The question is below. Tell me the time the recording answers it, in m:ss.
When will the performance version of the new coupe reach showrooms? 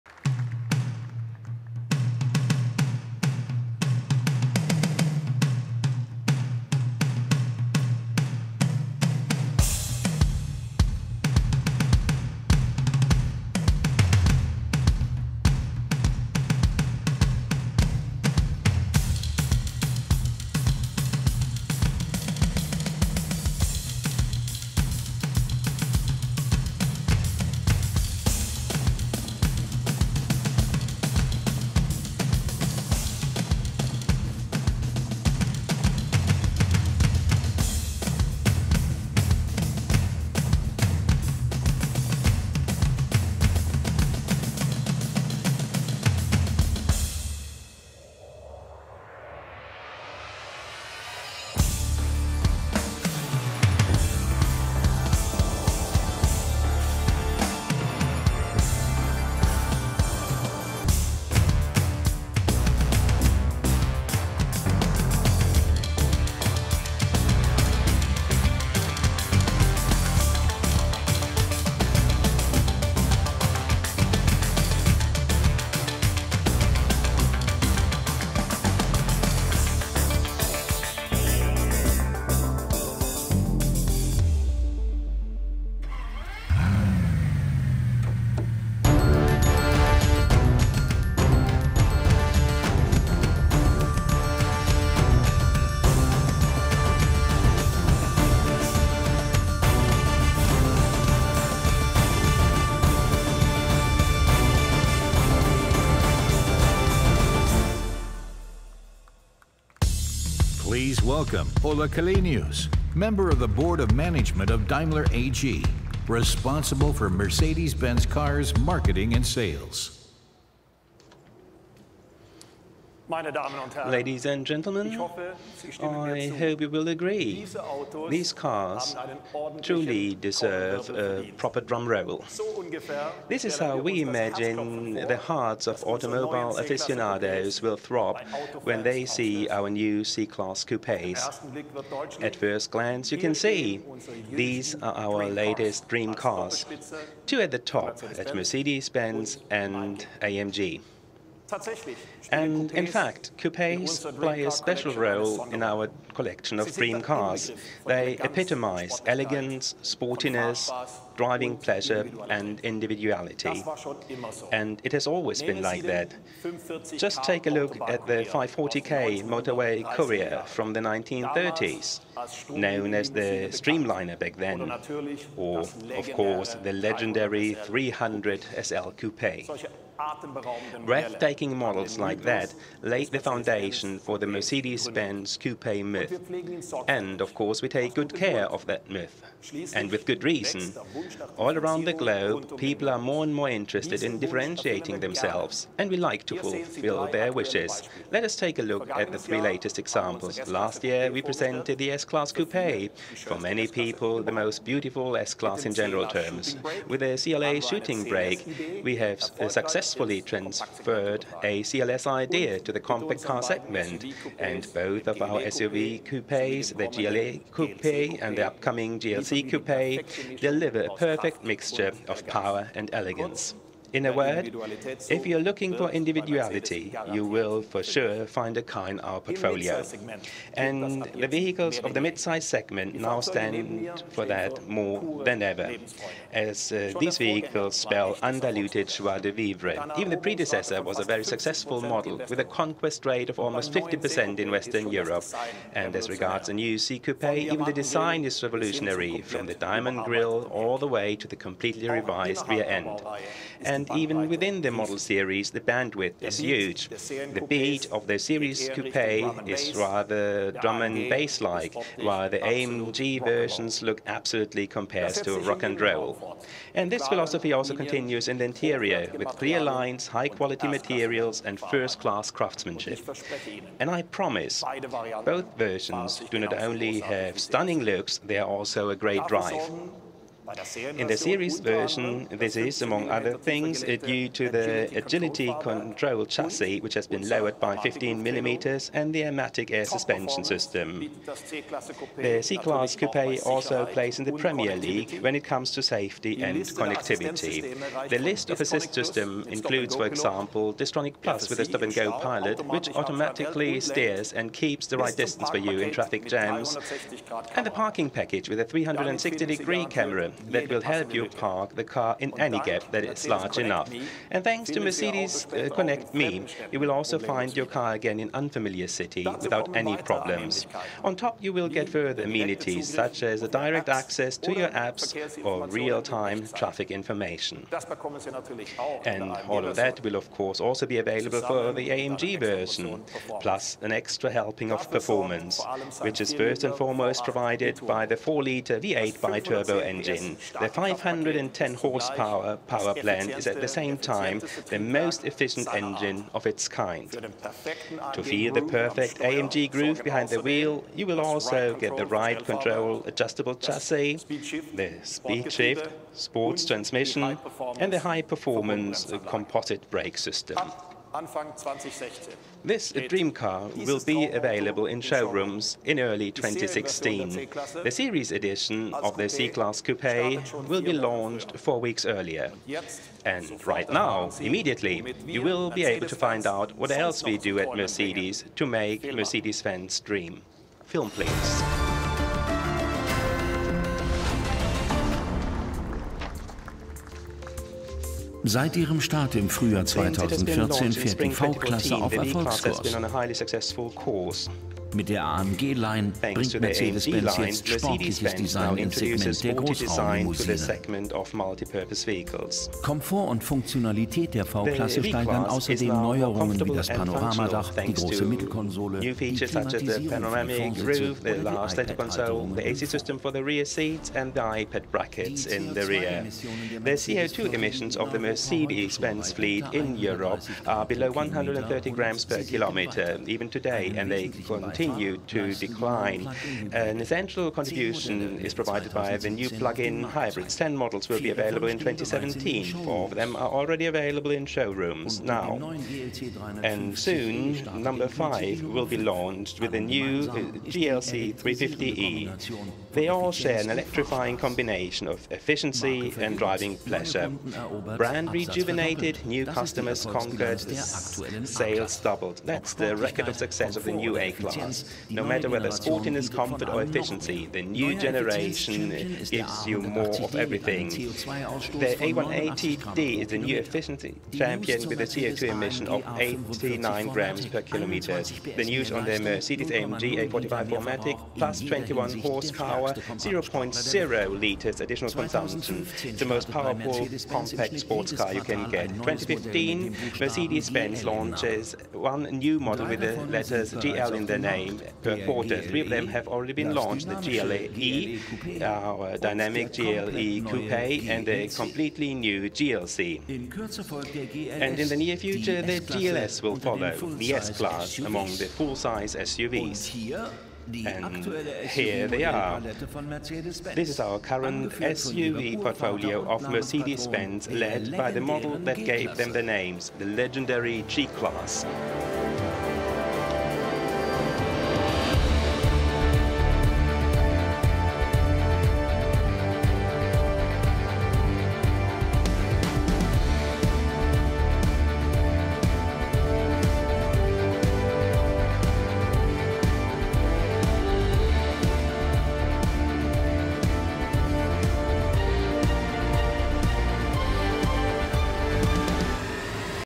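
6:05.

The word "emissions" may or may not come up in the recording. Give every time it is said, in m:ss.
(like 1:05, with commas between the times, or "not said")
6:57, 7:45.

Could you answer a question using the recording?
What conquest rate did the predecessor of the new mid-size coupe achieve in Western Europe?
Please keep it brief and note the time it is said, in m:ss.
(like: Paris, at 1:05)
almost 50%, at 4:03.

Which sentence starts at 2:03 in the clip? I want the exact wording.
Ladies and gentlemen, I hope you will agree.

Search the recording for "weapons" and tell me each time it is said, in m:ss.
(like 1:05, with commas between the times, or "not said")
not said.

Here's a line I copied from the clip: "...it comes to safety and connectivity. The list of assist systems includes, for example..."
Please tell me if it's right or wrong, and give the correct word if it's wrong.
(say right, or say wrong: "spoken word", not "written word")
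right.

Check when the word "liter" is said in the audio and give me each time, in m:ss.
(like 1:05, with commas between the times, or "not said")
5:38, 7:54.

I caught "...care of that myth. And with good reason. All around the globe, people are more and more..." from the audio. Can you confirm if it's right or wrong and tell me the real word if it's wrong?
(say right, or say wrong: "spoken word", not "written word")
right.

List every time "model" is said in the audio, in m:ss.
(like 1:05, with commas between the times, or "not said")
3:01, 4:01, 4:14, 7:10, 8:02, 8:28.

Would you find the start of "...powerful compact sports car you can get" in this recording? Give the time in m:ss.
7:56.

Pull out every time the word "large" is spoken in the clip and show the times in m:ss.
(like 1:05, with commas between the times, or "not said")
5:13, 6:51.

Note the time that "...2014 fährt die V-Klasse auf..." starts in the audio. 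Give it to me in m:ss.
6:29.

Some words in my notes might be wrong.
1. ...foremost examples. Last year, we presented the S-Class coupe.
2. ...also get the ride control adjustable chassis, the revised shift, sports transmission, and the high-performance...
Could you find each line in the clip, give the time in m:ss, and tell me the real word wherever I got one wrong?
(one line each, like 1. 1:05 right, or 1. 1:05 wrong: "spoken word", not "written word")
1. 3:19 wrong: "latest", not "foremost"
2. 5:51 wrong: "speed", not "revised".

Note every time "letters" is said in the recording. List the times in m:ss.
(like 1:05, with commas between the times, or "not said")
8:03.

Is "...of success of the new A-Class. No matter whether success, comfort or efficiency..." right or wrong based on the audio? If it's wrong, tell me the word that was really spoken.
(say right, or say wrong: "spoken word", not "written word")
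wrong: "sportiness", not "success".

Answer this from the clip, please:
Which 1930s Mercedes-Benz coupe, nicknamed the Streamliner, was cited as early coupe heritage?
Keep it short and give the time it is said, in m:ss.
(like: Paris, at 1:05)
540K motorway courier, at 2:48.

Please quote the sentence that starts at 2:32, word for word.
And in fact, coupes play a special role in our collection of dream cars.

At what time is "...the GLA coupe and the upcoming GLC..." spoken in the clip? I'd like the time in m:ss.
3:36.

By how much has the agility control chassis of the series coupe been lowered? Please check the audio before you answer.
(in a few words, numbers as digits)
15 millimeters.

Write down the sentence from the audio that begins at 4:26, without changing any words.
And this philosophy also continues in the interior, with clear lines, high-quality materials, and first-class craftsmanship.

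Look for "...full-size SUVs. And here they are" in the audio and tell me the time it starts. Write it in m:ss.
8:18.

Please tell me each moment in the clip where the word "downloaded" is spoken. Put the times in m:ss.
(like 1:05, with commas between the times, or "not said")
not said.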